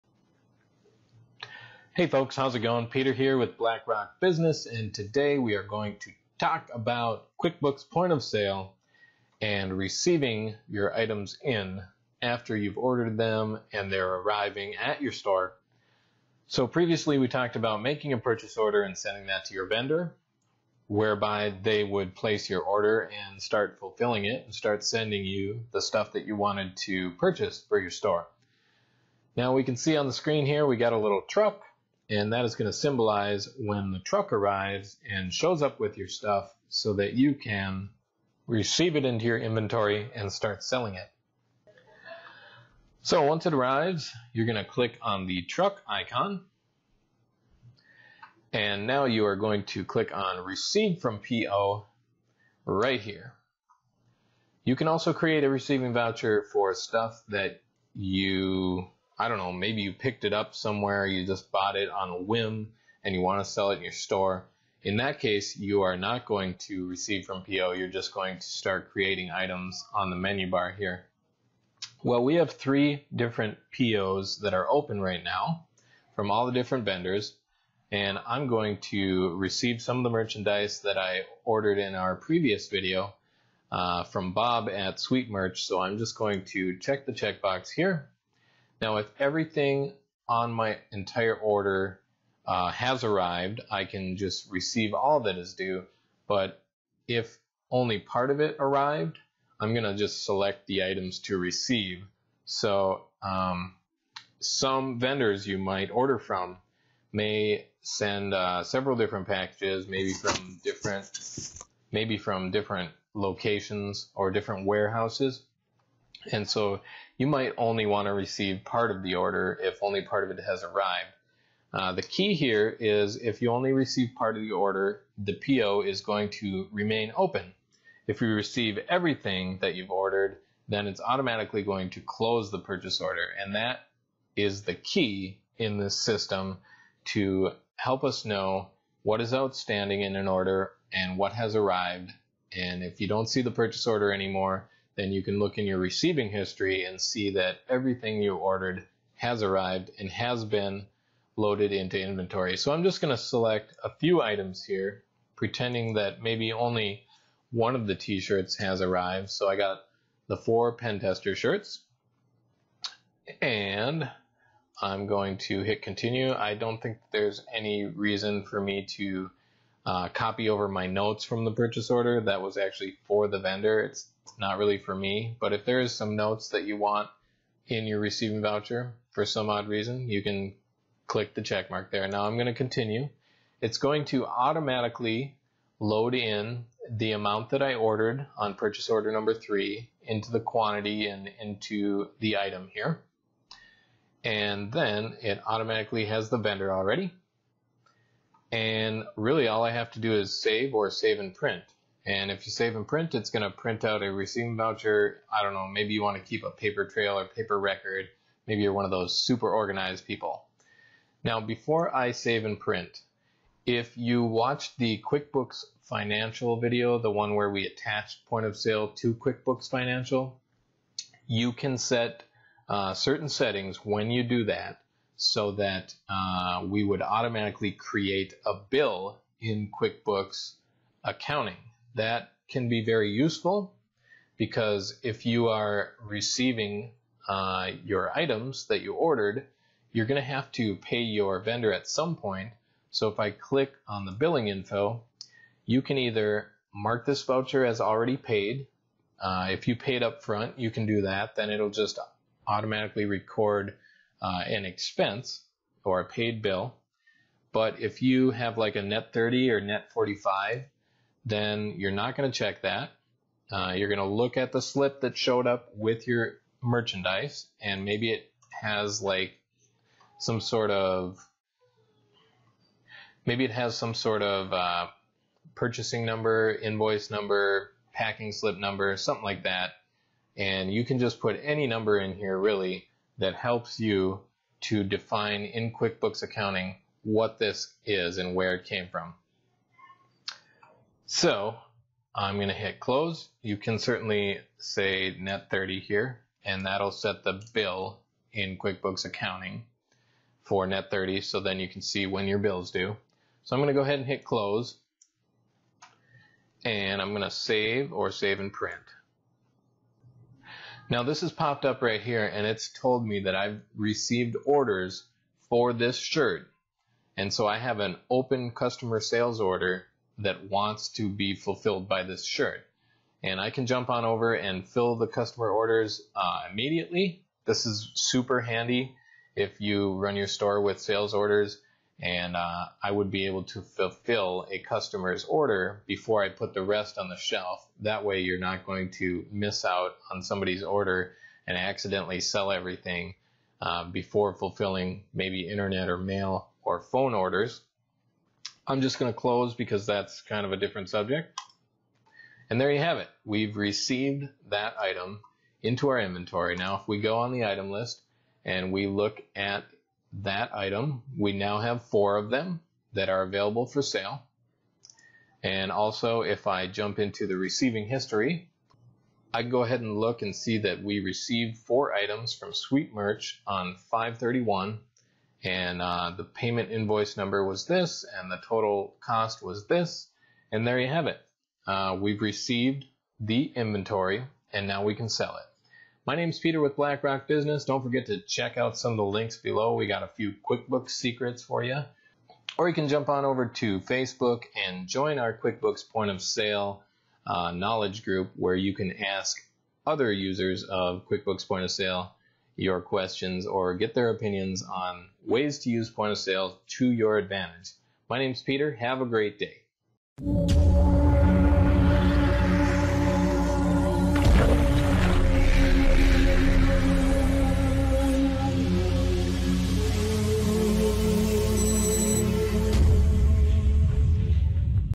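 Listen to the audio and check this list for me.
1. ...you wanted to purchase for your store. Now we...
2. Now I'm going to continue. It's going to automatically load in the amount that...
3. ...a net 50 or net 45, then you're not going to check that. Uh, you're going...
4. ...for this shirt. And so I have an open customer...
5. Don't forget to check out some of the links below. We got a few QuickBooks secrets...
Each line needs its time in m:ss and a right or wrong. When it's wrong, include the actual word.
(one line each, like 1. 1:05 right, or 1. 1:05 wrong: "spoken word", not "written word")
1. 0:26 right
2. 3:02 right
3. 4:18 wrong: "30", not "50"
4. 5:15 right
5. 6:27 right.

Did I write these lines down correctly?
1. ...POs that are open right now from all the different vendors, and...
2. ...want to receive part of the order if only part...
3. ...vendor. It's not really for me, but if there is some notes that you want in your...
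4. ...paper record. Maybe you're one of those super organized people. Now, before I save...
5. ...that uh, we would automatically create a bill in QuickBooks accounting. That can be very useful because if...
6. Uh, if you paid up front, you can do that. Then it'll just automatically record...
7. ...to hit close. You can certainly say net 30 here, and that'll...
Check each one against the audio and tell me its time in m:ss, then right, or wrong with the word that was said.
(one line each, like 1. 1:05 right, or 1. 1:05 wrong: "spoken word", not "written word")
1. 1:13 right
2. 1:57 right
3. 2:53 right
4. 3:27 right
5. 3:45 right
6. 4:09 right
7. 4:52 right.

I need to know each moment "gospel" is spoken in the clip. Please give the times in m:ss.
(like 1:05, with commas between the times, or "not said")
not said.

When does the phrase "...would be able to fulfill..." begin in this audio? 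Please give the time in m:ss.
5:32.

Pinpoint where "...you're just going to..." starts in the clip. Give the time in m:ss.
1:07.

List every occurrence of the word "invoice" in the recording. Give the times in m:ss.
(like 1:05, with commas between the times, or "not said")
4:36, 6:16.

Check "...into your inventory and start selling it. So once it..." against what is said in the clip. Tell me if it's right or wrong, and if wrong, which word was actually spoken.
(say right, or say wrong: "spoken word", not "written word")
right.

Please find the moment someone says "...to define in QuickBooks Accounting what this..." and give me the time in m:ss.
4:44.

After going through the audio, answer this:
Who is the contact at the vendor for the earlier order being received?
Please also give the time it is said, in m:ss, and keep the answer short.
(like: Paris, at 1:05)
Bob, at 1:24.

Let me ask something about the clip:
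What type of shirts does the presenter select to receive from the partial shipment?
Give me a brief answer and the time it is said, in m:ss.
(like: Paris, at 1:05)
pen tester shirts, at 2:40.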